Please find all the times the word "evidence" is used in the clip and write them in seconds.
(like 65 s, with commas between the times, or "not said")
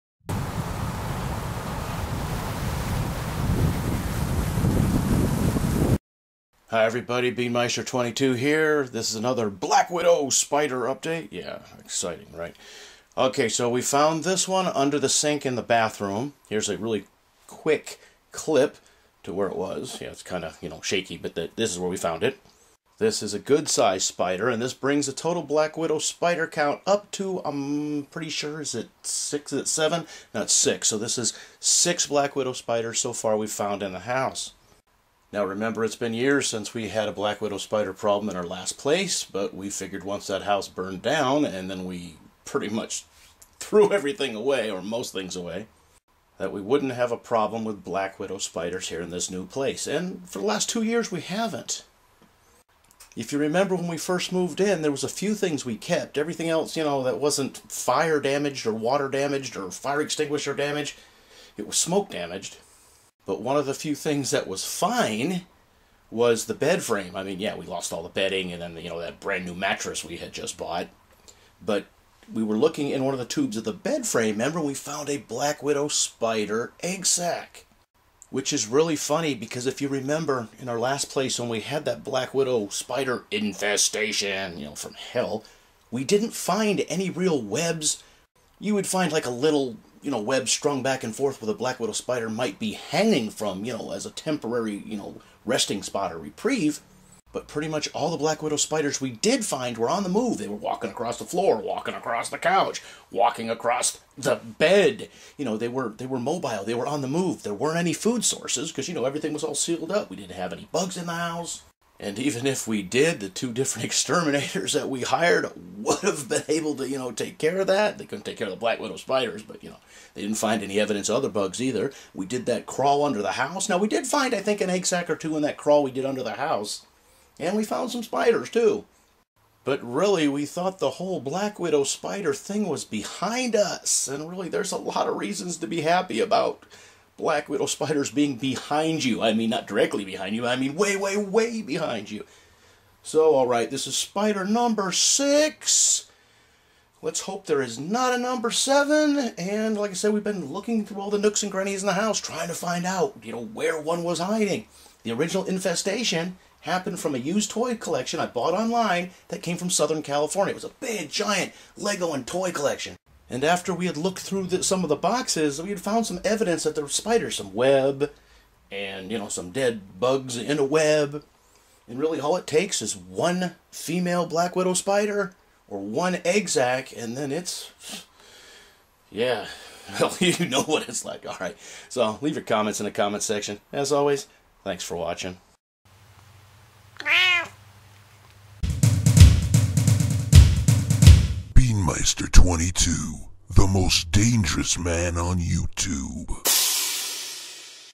120 s, 166 s.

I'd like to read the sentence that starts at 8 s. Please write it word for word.
This is another Black Widow spider update.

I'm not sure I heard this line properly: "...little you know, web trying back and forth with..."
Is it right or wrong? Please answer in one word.
wrong.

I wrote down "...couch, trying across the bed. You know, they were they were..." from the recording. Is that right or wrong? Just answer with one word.
wrong.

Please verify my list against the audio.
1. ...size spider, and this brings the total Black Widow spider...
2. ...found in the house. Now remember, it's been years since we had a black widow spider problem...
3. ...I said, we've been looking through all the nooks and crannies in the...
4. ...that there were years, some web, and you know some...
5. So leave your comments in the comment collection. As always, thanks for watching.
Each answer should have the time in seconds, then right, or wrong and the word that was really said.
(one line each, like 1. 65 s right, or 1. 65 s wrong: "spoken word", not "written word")
1. 23 s right
2. 33 s right
3. 149 s right
4. 166 s wrong: "spiders", not "years"
5. 181 s wrong: "section", not "collection".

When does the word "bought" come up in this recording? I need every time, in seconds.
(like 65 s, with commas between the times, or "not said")
70 s, 158 s.